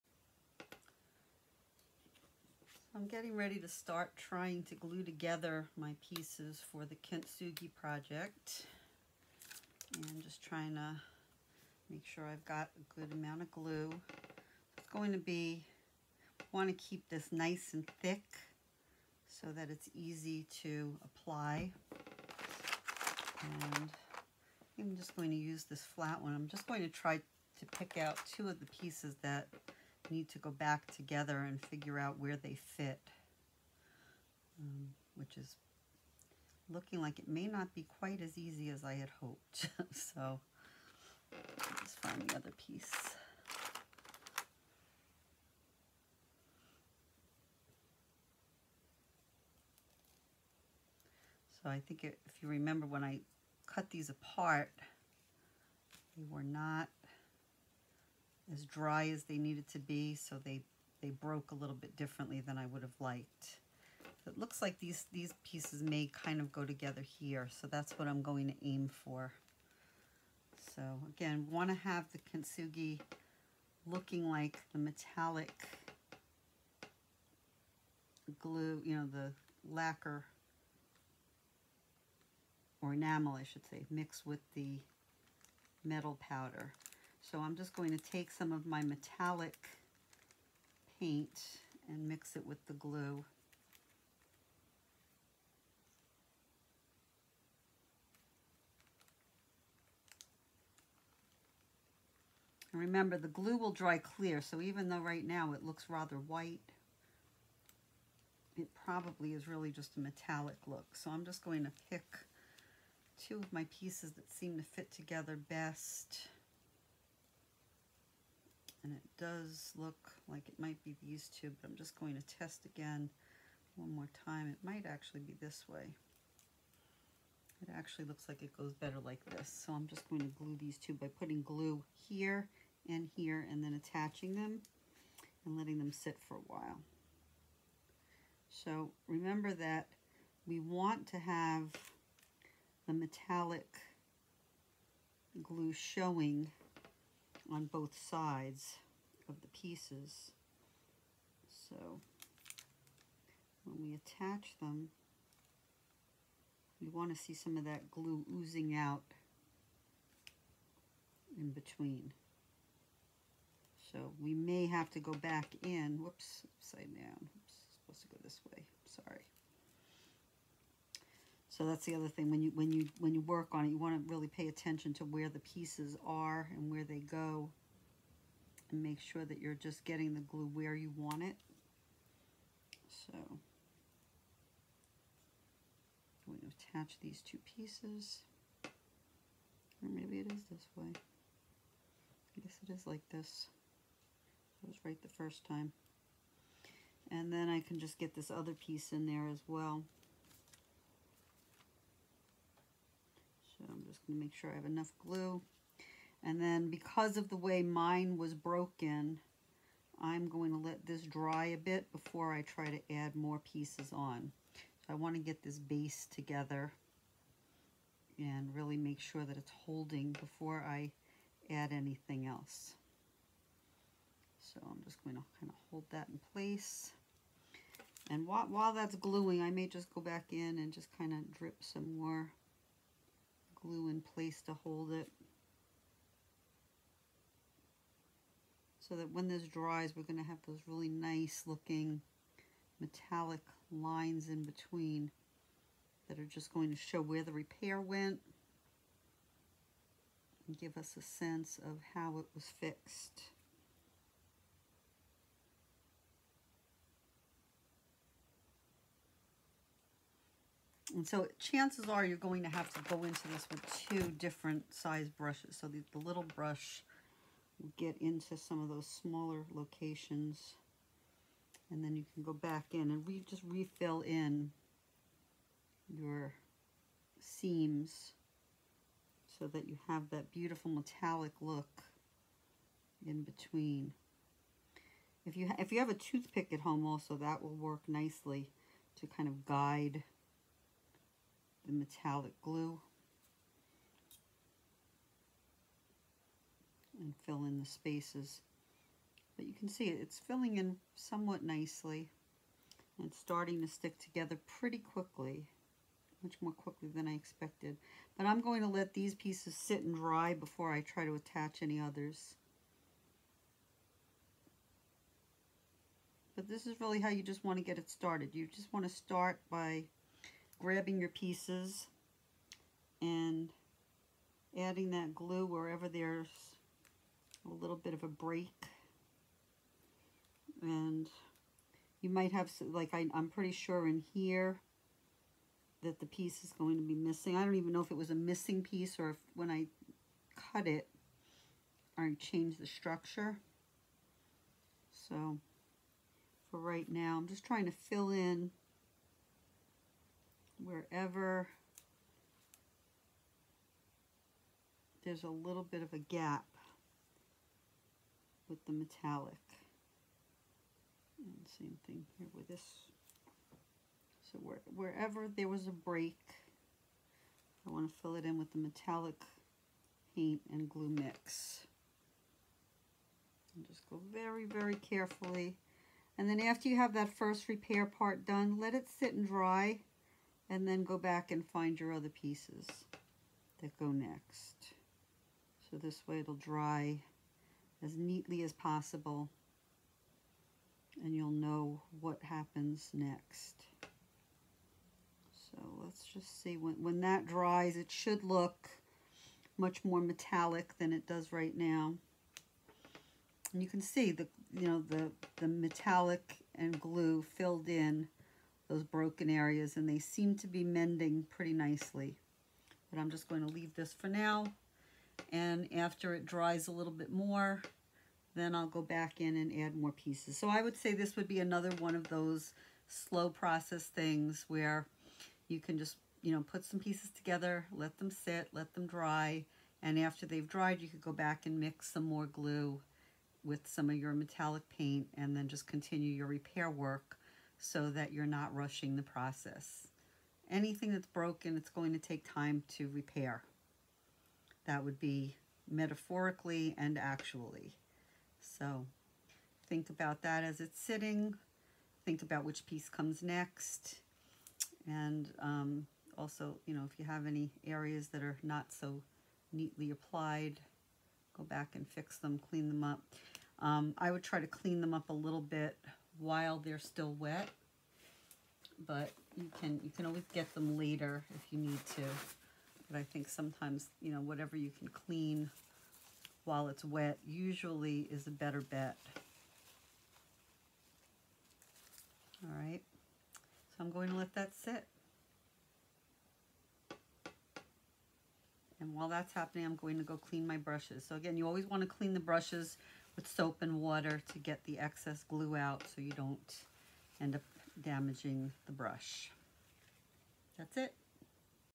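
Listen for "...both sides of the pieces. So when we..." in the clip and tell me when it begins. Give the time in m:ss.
2:27.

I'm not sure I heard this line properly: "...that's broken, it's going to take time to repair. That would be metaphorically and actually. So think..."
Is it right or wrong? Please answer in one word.
right.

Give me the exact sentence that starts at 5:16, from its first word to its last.
But this is really how you just want to get it started.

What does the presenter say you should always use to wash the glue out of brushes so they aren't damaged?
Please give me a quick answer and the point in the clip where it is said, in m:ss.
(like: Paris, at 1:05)
soap and water, at 8:13.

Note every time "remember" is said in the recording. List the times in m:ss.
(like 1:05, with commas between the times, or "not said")
0:52, 1:42, 2:19.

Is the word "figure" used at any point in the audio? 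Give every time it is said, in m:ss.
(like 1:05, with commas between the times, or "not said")
0:31.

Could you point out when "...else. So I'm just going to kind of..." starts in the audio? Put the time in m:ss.
3:42.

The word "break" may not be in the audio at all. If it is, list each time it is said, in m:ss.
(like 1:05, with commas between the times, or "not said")
5:28, 6:05.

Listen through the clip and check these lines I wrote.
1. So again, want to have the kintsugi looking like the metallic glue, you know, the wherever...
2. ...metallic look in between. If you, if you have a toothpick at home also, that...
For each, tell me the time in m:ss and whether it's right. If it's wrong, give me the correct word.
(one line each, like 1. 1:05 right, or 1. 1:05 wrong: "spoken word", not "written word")
1. 1:10 wrong: "lacquer", not "wherever"
2. 4:40 right.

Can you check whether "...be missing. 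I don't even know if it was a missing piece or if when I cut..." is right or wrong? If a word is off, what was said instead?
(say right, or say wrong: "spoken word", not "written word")
right.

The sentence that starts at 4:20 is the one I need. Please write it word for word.
And so chances are you're going to have to go into this with two different size brushes.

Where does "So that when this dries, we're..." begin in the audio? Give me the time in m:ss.
3:58.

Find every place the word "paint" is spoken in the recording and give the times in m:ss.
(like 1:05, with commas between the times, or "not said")
1:30, 6:10, 7:14.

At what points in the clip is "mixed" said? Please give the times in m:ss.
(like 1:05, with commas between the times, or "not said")
1:23.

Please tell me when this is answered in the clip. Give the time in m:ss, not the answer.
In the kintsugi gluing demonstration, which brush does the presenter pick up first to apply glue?
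0:25.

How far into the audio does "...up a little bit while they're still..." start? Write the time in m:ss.
7:44.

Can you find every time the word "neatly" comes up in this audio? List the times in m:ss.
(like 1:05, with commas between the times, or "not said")
6:27, 7:39.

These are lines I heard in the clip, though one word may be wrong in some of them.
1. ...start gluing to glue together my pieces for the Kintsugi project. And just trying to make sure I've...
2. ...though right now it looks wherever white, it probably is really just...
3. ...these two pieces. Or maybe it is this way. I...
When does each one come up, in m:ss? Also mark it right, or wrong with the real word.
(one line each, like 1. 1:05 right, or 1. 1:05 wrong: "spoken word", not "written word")
1. 0:03 wrong: "trying", not "gluing"
2. 1:44 wrong: "rather", not "wherever"
3. 3:06 right.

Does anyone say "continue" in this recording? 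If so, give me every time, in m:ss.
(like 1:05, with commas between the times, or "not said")
7:15.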